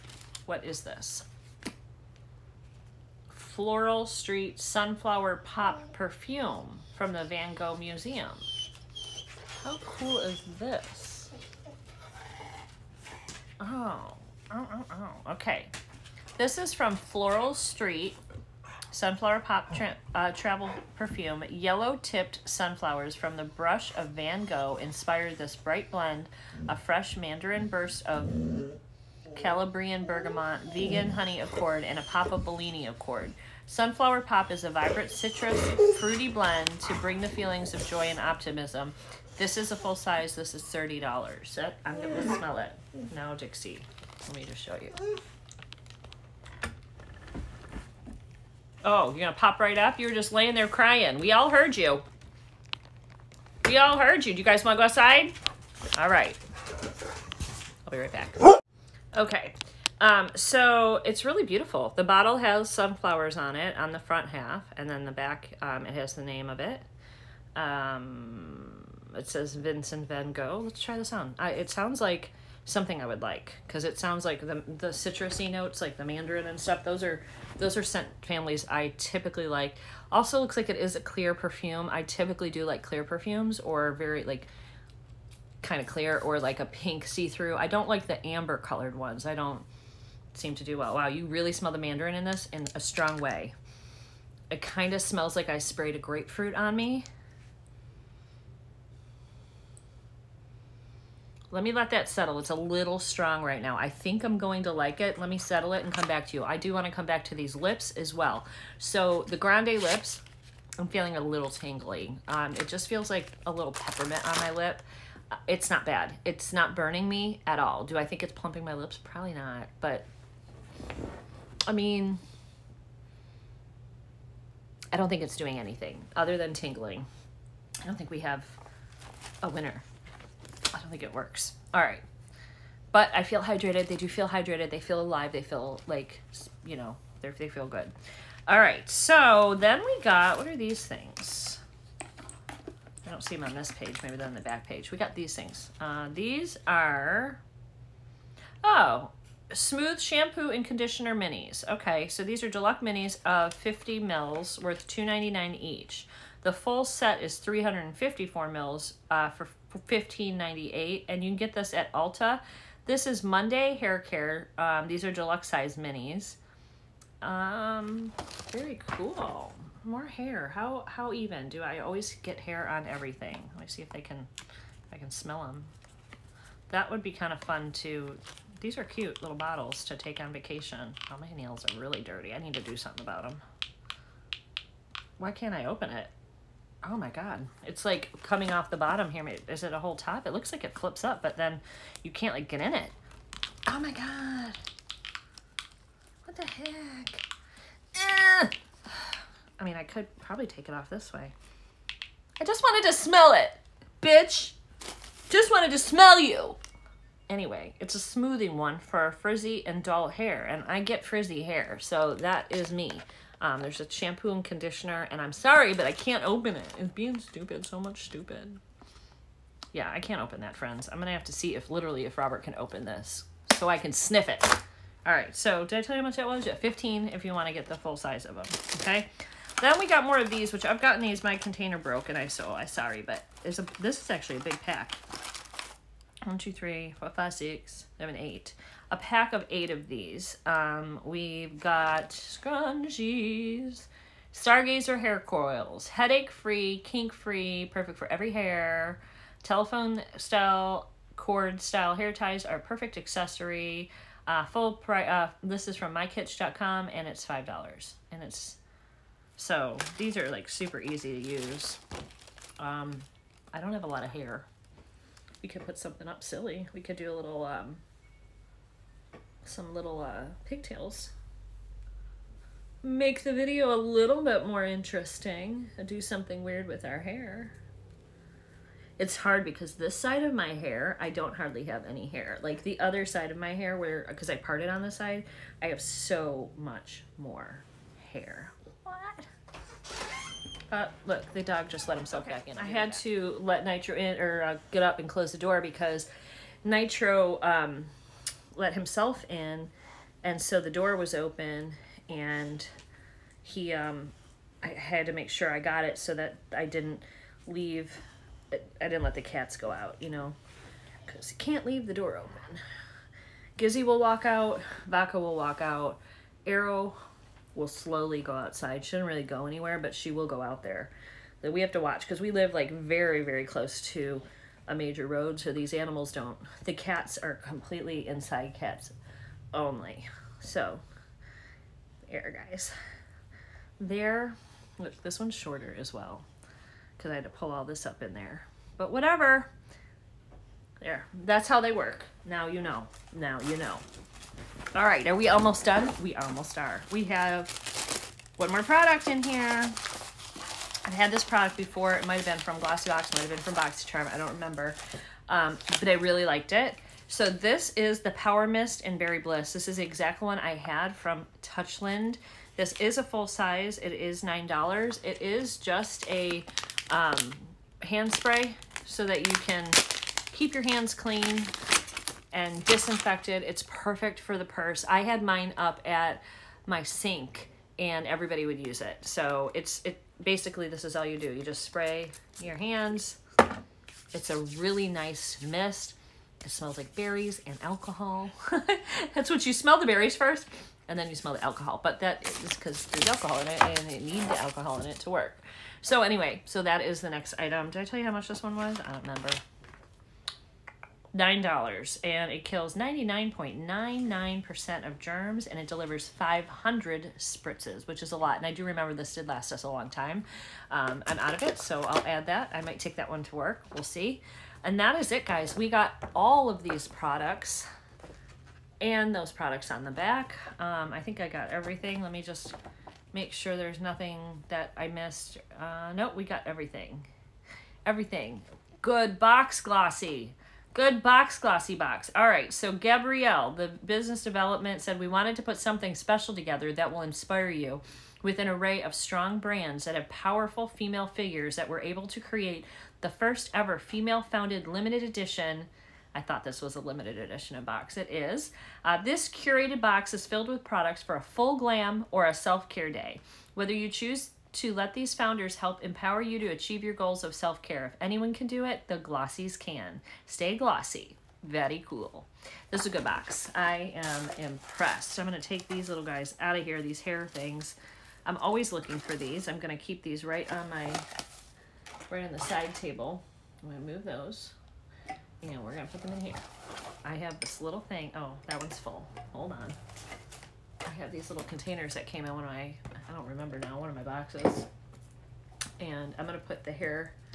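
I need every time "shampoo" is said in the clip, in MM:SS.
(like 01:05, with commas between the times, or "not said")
02:29, 03:33.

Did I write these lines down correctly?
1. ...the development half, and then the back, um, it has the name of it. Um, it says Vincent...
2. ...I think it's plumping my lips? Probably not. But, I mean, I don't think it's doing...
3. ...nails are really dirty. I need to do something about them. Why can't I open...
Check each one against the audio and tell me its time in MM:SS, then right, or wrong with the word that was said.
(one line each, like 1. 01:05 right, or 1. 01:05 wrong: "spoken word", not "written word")
1. 01:03 wrong: "front", not "development"
2. 01:57 right
3. 03:01 right.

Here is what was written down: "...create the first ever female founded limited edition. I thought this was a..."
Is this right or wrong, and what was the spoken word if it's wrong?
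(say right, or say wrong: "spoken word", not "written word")
right.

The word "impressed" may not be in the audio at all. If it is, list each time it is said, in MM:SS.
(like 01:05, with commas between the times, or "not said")
07:44.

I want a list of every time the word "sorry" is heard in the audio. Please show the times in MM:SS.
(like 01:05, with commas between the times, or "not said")
03:35, 03:52.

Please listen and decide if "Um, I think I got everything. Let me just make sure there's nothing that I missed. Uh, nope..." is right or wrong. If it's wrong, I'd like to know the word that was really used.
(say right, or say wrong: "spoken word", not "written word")
right.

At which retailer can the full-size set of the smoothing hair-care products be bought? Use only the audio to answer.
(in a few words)
Ulta.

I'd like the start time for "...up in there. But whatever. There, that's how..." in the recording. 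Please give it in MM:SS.
05:37.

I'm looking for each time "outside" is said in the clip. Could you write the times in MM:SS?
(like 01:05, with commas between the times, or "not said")
00:54, 05:18.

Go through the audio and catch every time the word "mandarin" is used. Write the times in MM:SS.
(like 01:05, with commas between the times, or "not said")
00:27, 01:16, 01:31.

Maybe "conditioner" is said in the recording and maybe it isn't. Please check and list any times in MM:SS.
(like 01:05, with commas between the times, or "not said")
02:30, 03:34.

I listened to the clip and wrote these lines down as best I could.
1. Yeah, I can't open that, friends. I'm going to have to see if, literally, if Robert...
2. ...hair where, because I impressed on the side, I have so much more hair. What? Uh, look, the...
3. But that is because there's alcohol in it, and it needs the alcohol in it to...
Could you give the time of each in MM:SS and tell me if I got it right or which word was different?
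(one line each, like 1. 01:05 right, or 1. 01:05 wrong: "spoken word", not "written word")
1. 03:39 right
2. 04:43 wrong: "parted", not "impressed"
3. 06:31 right.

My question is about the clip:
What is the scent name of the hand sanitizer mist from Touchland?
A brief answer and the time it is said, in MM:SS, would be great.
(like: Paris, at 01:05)
Berry Bliss, at 05:58.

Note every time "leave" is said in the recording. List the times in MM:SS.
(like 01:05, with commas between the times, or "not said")
05:07, 05:11.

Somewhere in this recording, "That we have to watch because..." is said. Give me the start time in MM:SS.
05:21.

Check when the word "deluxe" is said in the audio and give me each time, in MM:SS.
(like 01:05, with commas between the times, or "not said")
02:32, 02:45.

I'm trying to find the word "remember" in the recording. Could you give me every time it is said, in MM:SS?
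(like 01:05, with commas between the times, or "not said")
05:54, 06:39, 06:48, 08:03.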